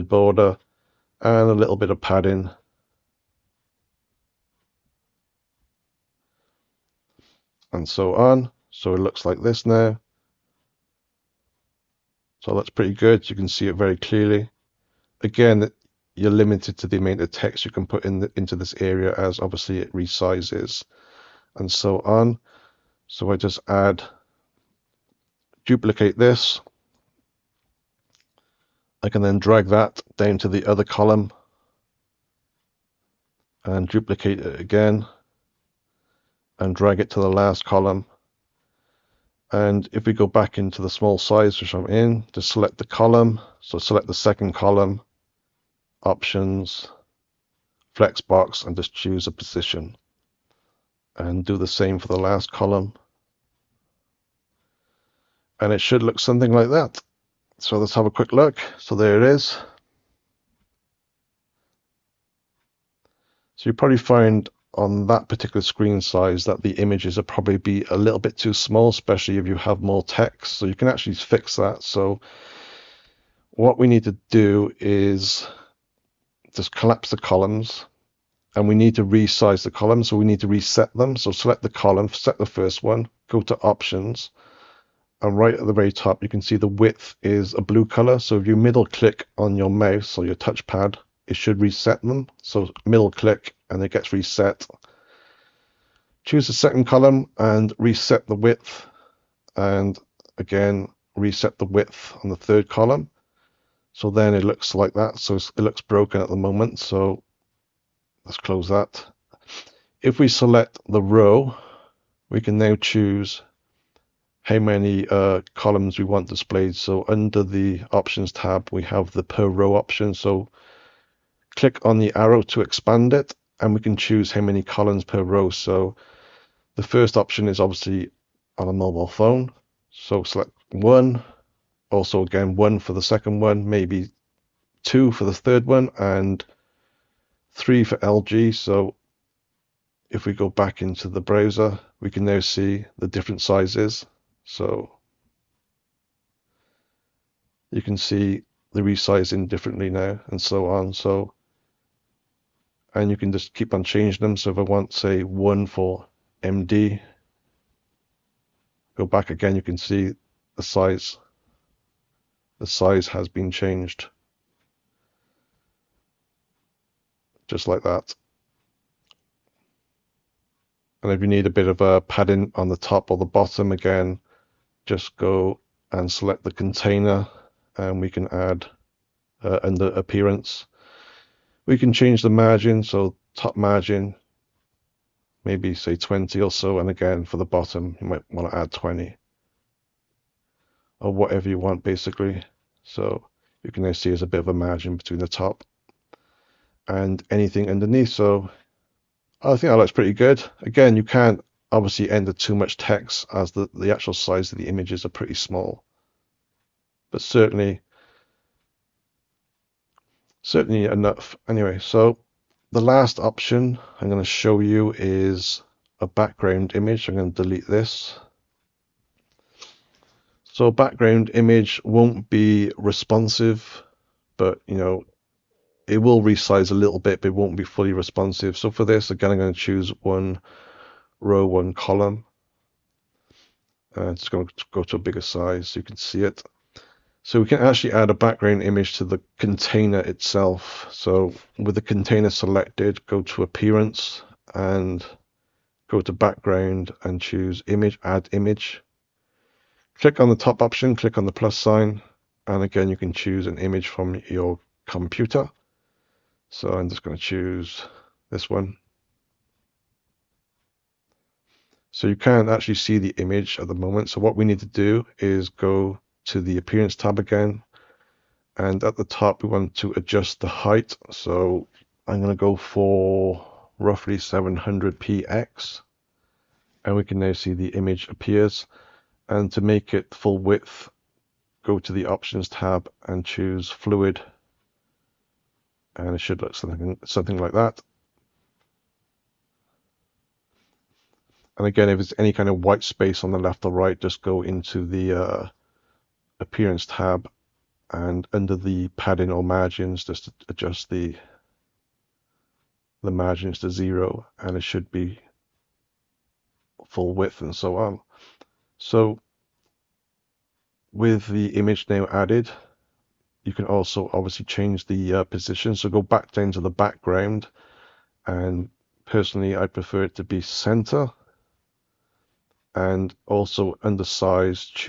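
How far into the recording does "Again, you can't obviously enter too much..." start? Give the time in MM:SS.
03:20.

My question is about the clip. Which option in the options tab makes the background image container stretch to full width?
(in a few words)
Fluid.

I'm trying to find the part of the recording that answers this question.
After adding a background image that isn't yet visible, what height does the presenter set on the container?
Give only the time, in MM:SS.
04:34.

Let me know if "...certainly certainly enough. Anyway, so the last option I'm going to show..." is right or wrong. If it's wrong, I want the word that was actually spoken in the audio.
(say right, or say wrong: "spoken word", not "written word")
right.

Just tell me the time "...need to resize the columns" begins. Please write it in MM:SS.
01:18.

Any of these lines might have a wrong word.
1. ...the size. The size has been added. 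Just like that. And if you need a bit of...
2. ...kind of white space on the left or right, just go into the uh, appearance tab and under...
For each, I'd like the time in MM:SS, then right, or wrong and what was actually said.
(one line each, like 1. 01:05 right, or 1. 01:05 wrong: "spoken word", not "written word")
1. 02:40 wrong: "changed", not "added"
2. 04:52 right.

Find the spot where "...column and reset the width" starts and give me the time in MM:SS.
01:36.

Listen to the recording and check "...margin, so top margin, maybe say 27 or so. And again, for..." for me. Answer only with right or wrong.
wrong.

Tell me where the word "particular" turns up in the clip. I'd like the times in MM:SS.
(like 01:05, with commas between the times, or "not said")
01:05.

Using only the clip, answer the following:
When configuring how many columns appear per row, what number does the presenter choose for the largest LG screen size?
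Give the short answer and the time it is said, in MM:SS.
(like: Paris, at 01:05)
3, at 02:17.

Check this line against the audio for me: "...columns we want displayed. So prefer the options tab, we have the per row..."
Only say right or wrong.
wrong.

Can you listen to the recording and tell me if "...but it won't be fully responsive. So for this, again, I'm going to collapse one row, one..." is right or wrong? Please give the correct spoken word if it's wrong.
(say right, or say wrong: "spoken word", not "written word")
wrong: "choose", not "collapse".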